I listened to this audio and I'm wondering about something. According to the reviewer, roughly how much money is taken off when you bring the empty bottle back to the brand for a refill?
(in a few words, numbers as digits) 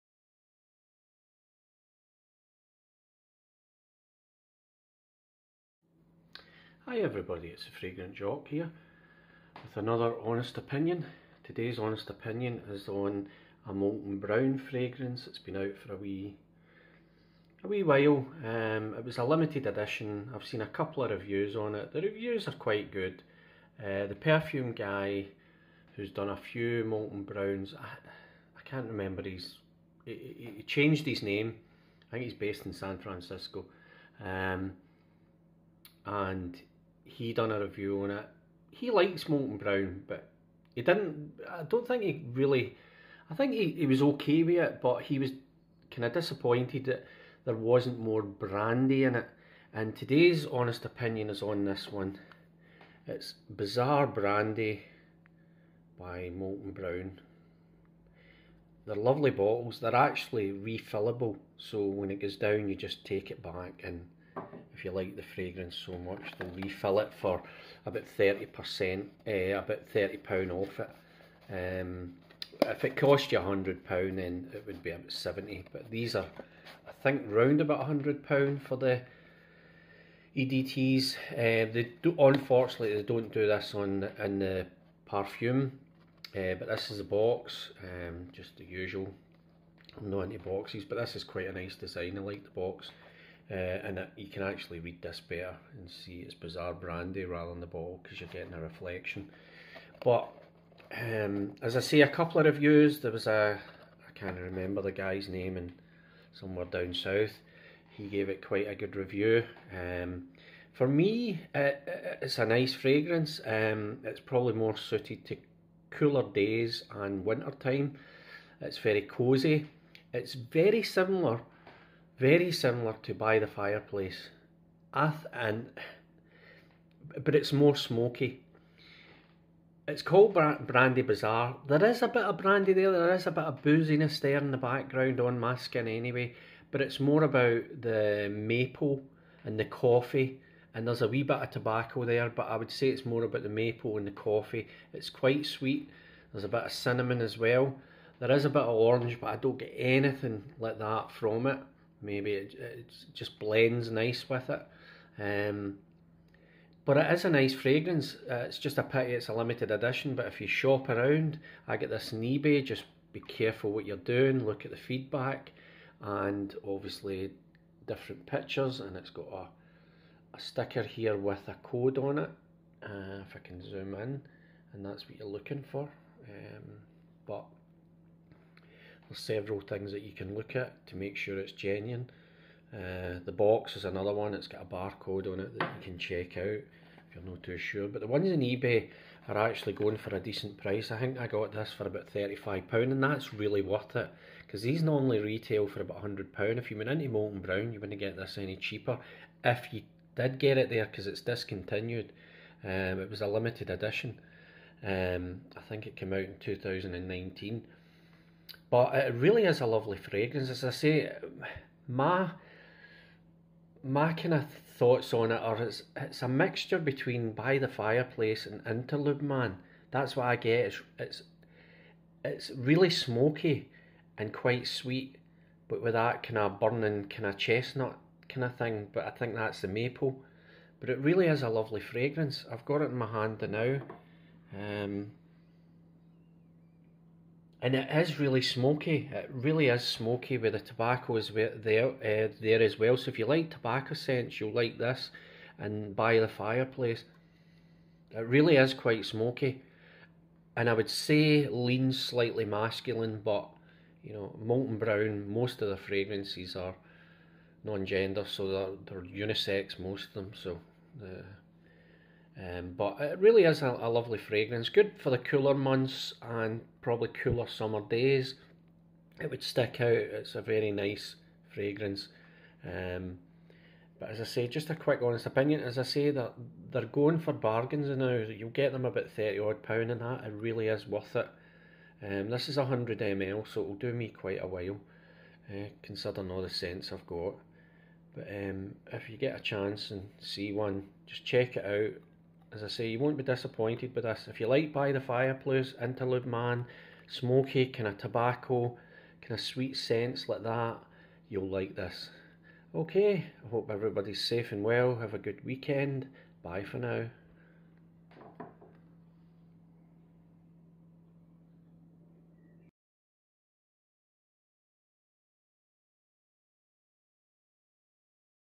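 £30.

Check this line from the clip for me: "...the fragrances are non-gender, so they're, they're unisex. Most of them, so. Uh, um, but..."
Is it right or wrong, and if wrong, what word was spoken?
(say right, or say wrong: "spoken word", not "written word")
right.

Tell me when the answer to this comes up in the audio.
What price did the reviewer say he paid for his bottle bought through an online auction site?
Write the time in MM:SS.
03:12.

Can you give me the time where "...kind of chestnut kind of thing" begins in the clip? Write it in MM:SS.
03:47.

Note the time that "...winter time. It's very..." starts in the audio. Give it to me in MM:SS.
01:57.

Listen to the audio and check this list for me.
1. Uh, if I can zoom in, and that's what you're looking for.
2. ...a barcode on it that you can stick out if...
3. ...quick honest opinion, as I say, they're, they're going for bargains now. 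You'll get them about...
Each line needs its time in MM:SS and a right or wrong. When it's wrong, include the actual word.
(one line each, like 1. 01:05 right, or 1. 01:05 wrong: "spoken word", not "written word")
1. 02:52 right
2. 03:04 wrong: "check", not "stick"
3. 04:34 right.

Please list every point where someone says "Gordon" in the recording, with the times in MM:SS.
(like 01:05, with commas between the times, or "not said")
not said.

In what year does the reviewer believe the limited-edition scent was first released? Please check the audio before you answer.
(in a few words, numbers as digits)
2019.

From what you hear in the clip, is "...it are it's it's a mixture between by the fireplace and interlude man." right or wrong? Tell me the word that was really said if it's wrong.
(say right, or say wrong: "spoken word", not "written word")
right.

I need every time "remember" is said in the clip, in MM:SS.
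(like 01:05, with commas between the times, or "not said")
00:28, 01:44.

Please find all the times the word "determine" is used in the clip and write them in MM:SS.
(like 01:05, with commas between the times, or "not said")
not said.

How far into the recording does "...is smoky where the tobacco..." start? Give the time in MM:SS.
03:59.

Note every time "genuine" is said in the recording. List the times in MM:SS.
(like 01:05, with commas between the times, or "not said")
03:01.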